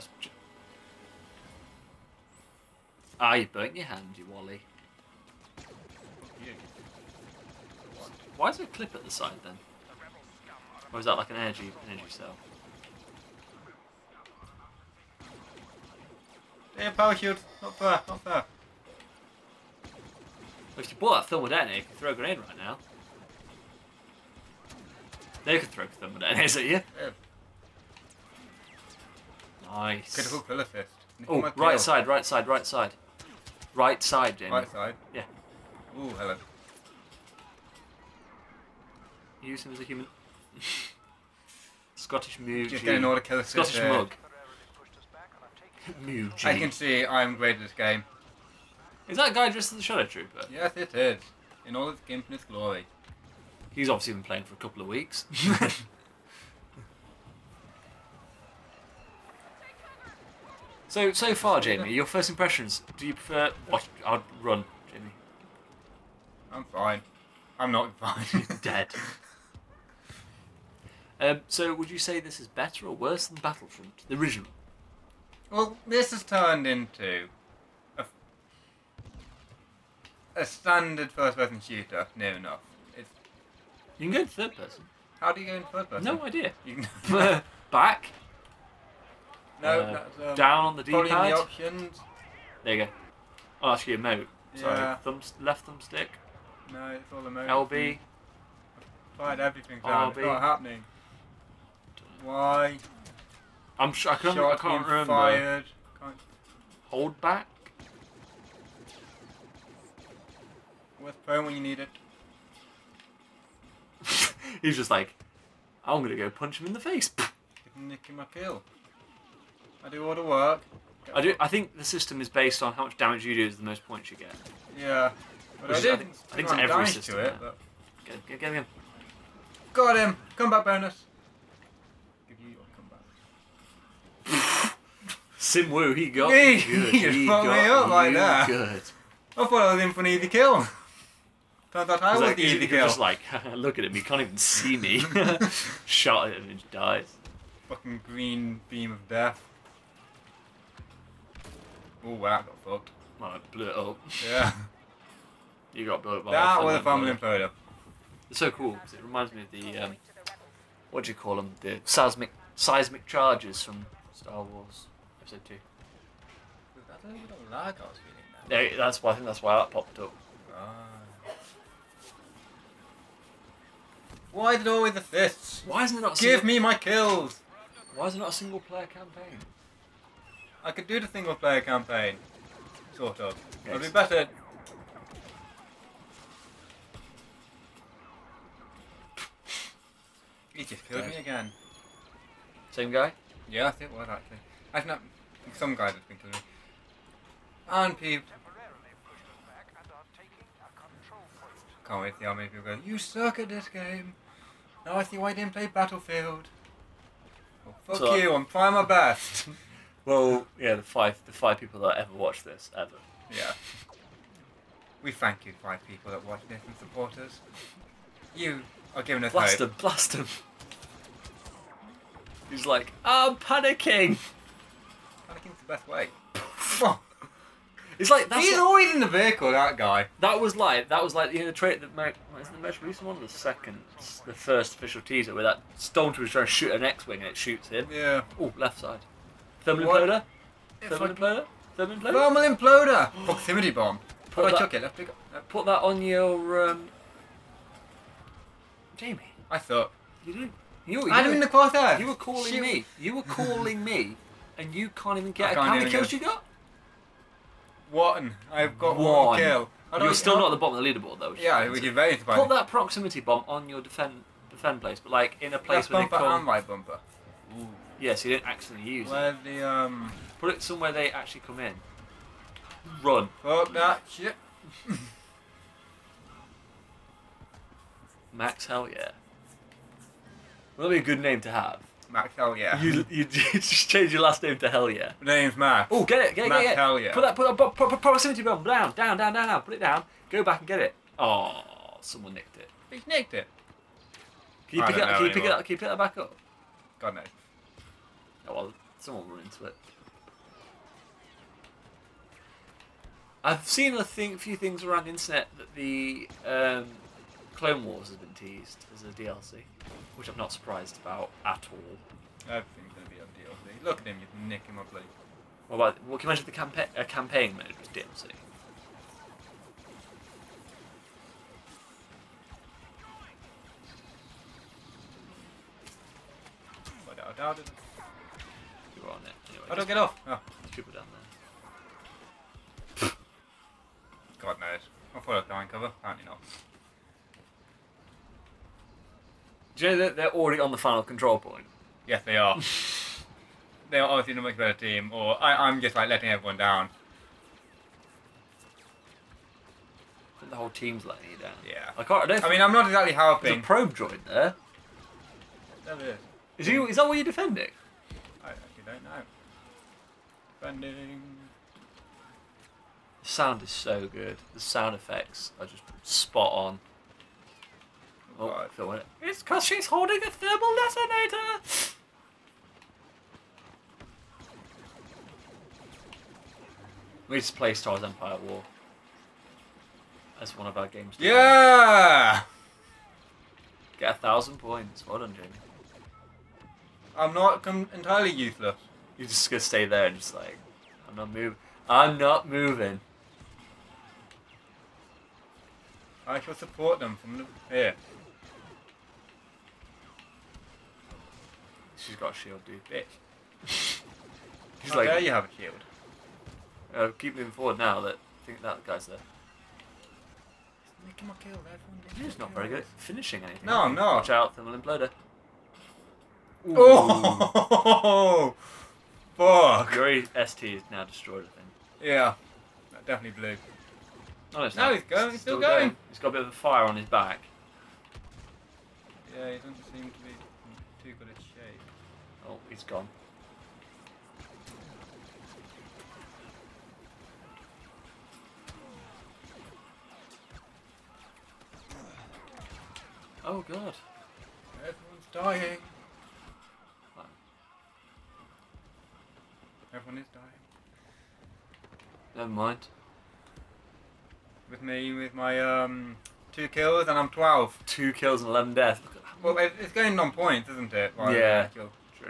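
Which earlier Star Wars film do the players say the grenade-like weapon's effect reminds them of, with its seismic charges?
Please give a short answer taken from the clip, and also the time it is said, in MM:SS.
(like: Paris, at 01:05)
Star Wars Episode Two, at 02:44.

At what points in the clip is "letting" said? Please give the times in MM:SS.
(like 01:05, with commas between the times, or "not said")
05:46, 05:51.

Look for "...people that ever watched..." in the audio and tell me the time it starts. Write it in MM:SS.
03:31.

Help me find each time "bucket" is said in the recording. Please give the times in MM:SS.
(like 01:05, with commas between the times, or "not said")
not said.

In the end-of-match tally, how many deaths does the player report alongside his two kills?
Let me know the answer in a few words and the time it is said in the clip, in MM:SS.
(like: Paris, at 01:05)
11, at 07:38.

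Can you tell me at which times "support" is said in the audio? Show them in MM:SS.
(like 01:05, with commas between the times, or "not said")
03:36, 06:36.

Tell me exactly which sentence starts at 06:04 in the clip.
The sound effects are just spot on.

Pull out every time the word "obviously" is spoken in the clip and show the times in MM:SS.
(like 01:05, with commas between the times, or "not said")
00:53, 05:44.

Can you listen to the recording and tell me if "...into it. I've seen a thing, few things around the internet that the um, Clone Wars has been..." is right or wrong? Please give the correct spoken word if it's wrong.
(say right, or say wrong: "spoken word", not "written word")
right.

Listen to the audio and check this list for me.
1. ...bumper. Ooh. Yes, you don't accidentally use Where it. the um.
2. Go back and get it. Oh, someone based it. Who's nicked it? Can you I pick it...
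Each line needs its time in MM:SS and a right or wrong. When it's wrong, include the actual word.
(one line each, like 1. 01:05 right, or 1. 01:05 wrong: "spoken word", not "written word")
1. 04:26 right
2. 04:50 wrong: "nicked", not "based".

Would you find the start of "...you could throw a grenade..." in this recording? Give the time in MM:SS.
00:21.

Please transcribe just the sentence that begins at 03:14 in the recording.
have not some guy that's been killing me.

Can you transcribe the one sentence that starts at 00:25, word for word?
They could throw thermodetonators at you.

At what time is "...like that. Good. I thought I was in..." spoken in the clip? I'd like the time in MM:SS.
02:17.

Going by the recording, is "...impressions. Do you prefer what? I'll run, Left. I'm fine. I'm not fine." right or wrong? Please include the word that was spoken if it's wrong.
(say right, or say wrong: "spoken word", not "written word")
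wrong: "Jamie", not "Left".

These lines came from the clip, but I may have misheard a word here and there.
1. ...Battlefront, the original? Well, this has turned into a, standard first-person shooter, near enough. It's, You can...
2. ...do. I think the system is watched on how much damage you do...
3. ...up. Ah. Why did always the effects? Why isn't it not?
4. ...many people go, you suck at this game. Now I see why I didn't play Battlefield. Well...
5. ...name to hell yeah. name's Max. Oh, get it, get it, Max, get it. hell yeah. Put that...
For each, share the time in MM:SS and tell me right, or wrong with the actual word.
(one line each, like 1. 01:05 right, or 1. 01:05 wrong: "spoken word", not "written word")
1. 01:13 right
2. 02:01 wrong: "based", not "watched"
3. 02:49 wrong: "fists", not "effects"
4. 03:22 right
5. 04:44 right.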